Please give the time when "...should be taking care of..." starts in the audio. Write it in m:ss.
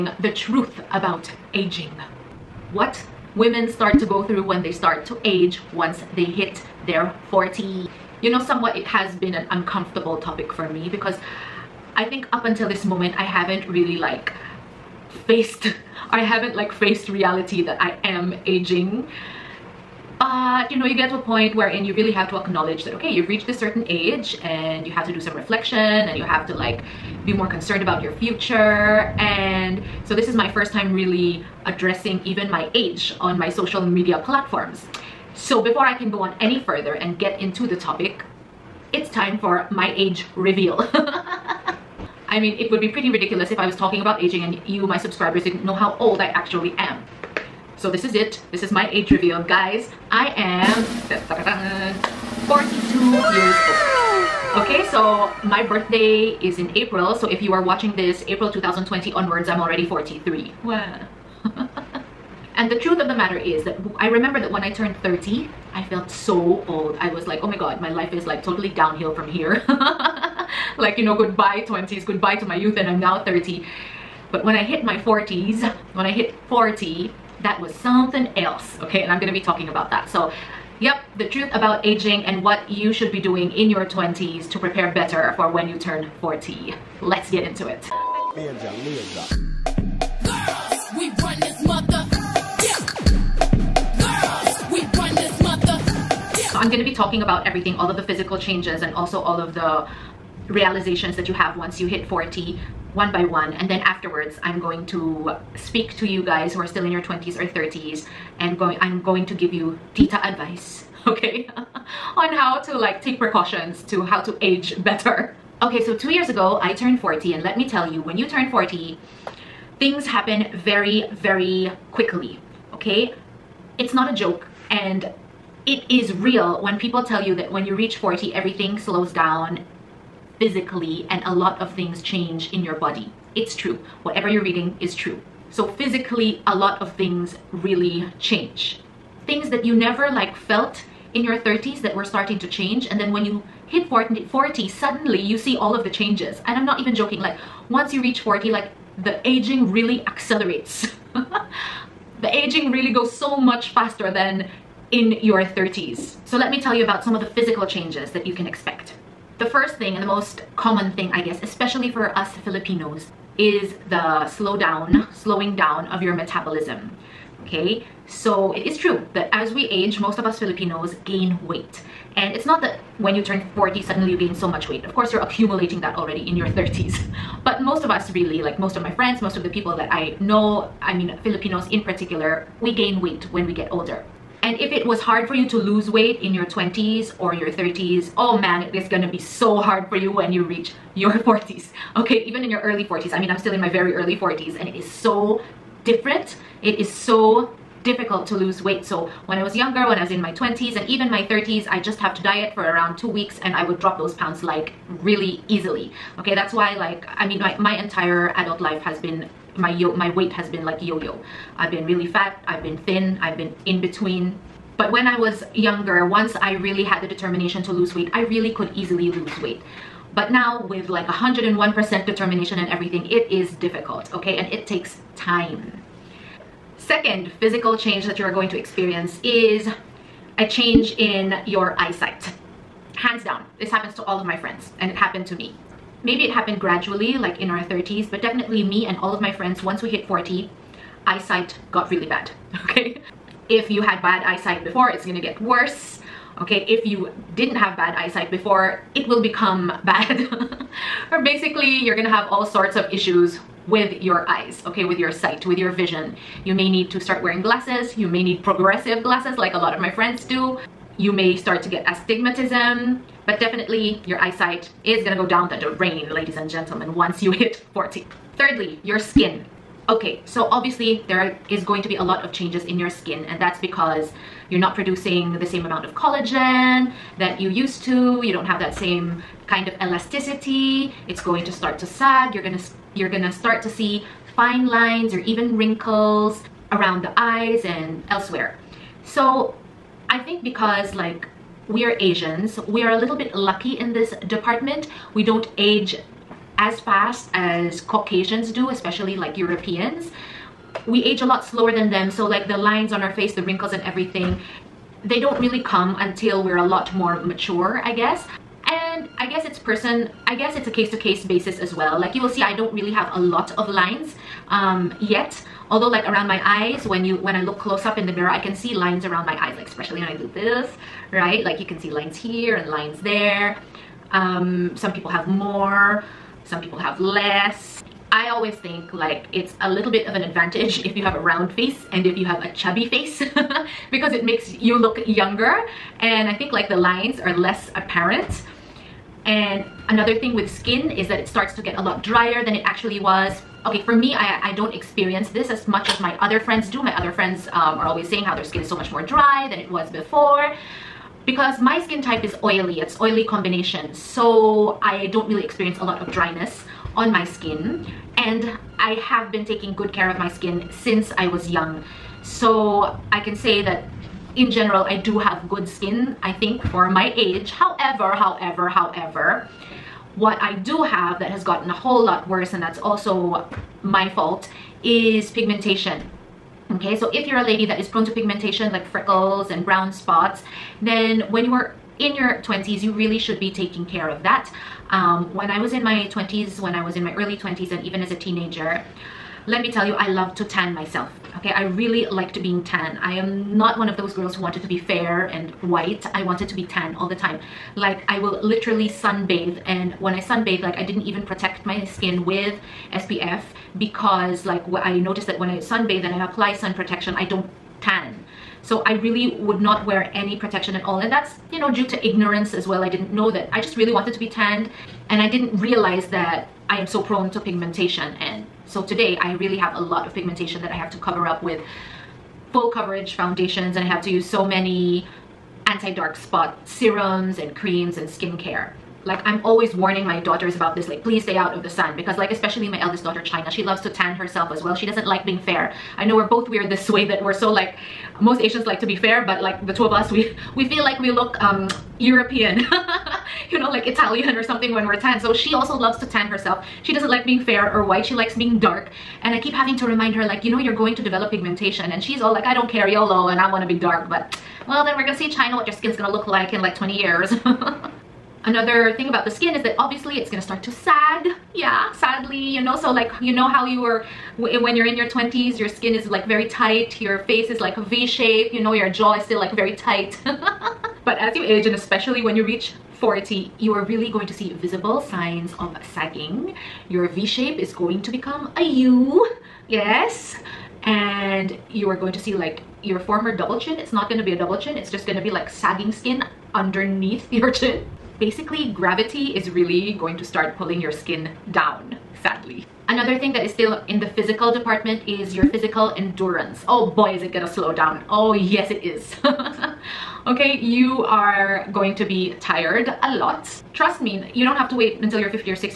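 6:23.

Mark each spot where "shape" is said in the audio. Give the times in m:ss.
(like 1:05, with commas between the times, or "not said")
7:48, 7:57.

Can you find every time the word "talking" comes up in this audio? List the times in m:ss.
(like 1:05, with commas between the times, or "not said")
0:43, 1:19, 1:36.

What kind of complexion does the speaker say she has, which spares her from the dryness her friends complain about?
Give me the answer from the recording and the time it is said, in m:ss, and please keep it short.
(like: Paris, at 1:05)
oily combination, at 5:53.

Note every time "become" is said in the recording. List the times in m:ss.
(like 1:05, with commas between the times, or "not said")
4:09, 7:58.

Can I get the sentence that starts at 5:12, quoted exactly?
Like you will see, I don't really have a lot of lines um, yet.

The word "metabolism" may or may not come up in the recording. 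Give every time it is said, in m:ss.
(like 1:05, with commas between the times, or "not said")
2:46.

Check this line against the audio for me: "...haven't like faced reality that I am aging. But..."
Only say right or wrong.
right.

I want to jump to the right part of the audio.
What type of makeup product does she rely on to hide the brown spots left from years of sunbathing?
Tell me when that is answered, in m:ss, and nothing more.
7:02.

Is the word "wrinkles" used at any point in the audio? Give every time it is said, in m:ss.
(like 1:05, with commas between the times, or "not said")
4:45, 5:03.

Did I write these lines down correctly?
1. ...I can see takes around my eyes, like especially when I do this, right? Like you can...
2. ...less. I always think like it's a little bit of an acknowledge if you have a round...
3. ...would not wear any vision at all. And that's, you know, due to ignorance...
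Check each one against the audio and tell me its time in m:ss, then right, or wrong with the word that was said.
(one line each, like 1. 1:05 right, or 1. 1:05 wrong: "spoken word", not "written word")
1. 5:18 wrong: "lines", not "takes"
2. 5:26 wrong: "advantage", not "acknowledge"
3. 6:49 wrong: "protection", not "vision".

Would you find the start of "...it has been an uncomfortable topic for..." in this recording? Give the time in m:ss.
0:08.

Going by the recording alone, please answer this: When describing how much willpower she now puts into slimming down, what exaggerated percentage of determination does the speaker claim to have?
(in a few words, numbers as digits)
101%.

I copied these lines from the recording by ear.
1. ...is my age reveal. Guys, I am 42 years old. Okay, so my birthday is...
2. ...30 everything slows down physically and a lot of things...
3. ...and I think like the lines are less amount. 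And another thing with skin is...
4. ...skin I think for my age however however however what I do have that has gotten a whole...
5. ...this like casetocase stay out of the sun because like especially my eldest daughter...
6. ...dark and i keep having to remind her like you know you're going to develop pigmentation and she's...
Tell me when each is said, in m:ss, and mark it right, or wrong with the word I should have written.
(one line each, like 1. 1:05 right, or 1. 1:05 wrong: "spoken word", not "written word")
1. 0:48 right
2. 2:07 wrong: "40", not "30"
3. 5:35 wrong: "apparent", not "amount"
4. 6:05 right
5. 7:10 wrong: "please", not "casetocase"
6. 7:28 right.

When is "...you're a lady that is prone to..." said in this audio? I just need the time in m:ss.
6:17.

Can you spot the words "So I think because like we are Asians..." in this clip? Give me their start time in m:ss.
4:49.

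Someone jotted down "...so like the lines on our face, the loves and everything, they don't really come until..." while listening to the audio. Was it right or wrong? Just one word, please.
wrong.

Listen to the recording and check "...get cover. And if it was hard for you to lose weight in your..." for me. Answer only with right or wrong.
wrong.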